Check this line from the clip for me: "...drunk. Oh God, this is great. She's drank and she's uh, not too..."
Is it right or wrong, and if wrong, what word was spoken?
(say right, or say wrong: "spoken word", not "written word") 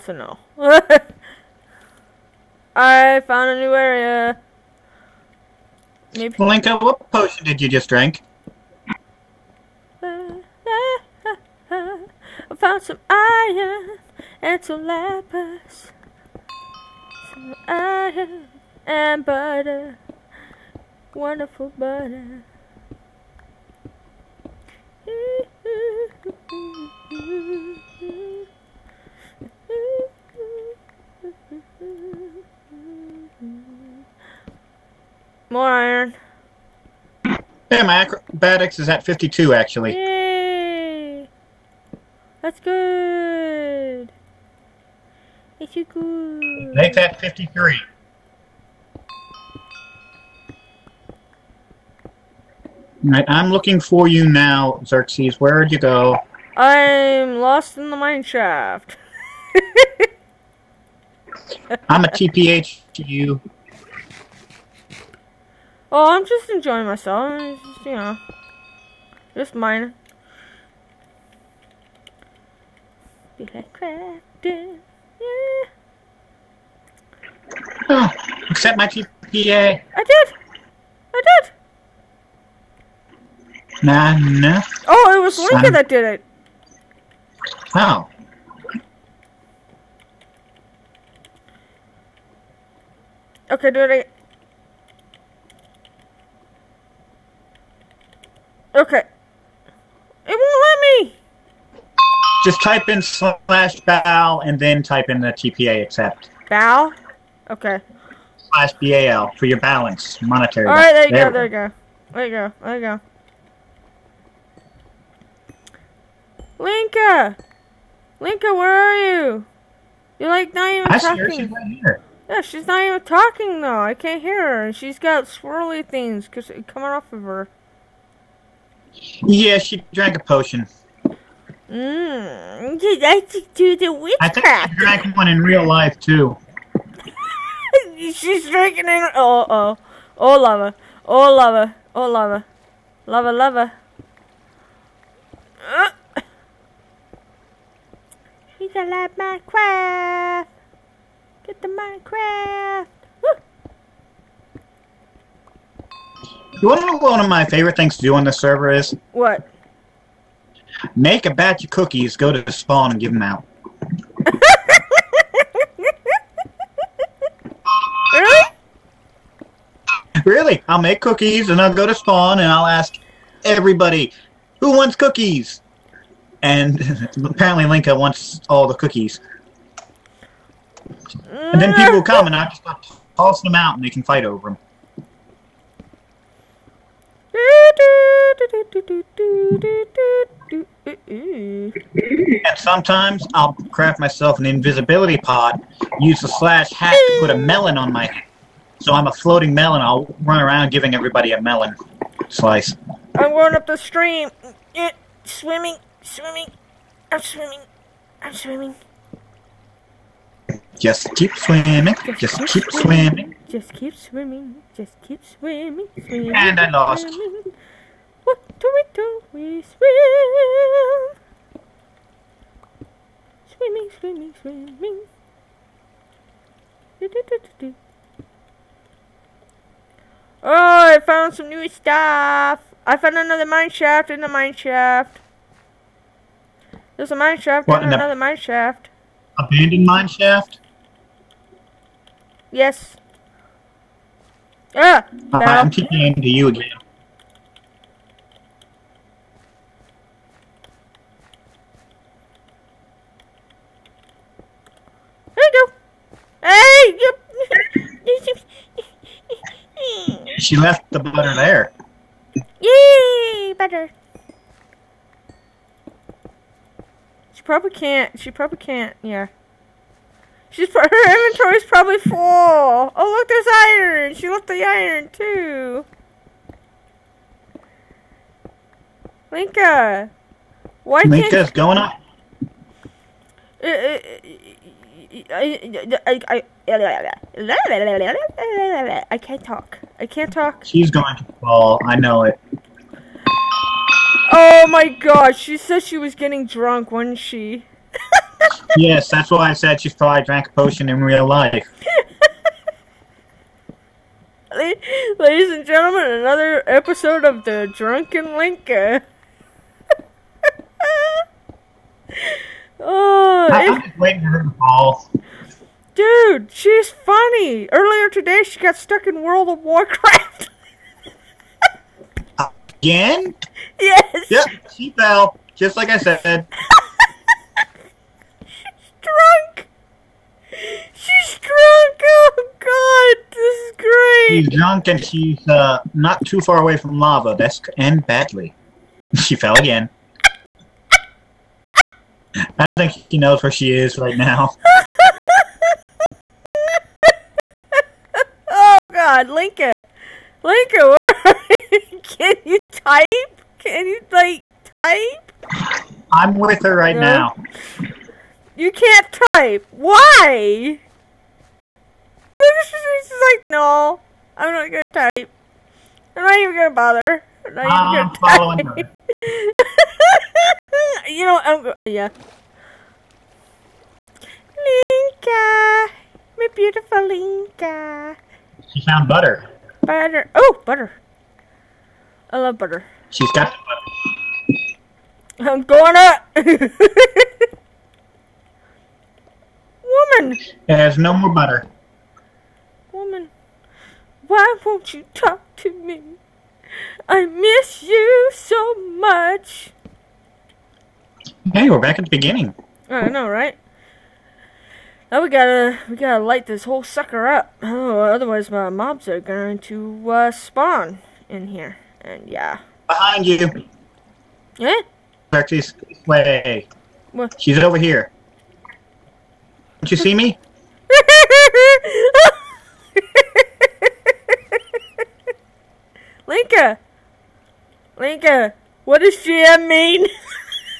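wrong: "drunk", not "drank".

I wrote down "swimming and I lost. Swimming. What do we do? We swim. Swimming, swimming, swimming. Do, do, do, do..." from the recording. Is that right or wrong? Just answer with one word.
right.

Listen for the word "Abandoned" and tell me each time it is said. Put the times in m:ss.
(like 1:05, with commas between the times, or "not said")
3:59.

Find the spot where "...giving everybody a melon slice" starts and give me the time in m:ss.
3:20.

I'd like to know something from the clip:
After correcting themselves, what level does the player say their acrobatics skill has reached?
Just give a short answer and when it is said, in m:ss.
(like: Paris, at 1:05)
53, at 0:46.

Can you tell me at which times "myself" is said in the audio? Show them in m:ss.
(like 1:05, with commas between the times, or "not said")
1:06, 3:13.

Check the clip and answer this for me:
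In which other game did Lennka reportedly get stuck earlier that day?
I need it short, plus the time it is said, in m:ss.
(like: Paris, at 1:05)
World of Warcraft, at 5:19.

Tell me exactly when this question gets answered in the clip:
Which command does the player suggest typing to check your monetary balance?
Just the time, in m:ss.
1:48.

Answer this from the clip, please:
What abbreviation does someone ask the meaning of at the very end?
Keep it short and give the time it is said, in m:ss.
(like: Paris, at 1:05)
GM, at 7:09.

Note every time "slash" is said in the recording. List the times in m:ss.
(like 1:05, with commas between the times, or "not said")
1:43, 1:48, 3:16.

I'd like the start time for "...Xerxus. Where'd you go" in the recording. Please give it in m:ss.
0:54.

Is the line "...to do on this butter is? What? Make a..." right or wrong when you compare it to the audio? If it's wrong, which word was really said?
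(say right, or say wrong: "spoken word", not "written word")
wrong: "server", not "butter".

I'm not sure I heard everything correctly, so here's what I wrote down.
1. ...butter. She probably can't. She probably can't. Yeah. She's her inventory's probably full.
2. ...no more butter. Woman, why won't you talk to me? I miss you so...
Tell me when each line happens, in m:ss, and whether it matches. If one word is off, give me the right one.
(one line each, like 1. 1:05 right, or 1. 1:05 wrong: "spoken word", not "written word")
1. 4:23 right
2. 6:30 right.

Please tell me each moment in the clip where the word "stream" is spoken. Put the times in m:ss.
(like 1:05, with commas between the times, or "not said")
3:23.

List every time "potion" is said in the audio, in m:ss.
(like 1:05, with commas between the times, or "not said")
0:07, 2:10, 5:00.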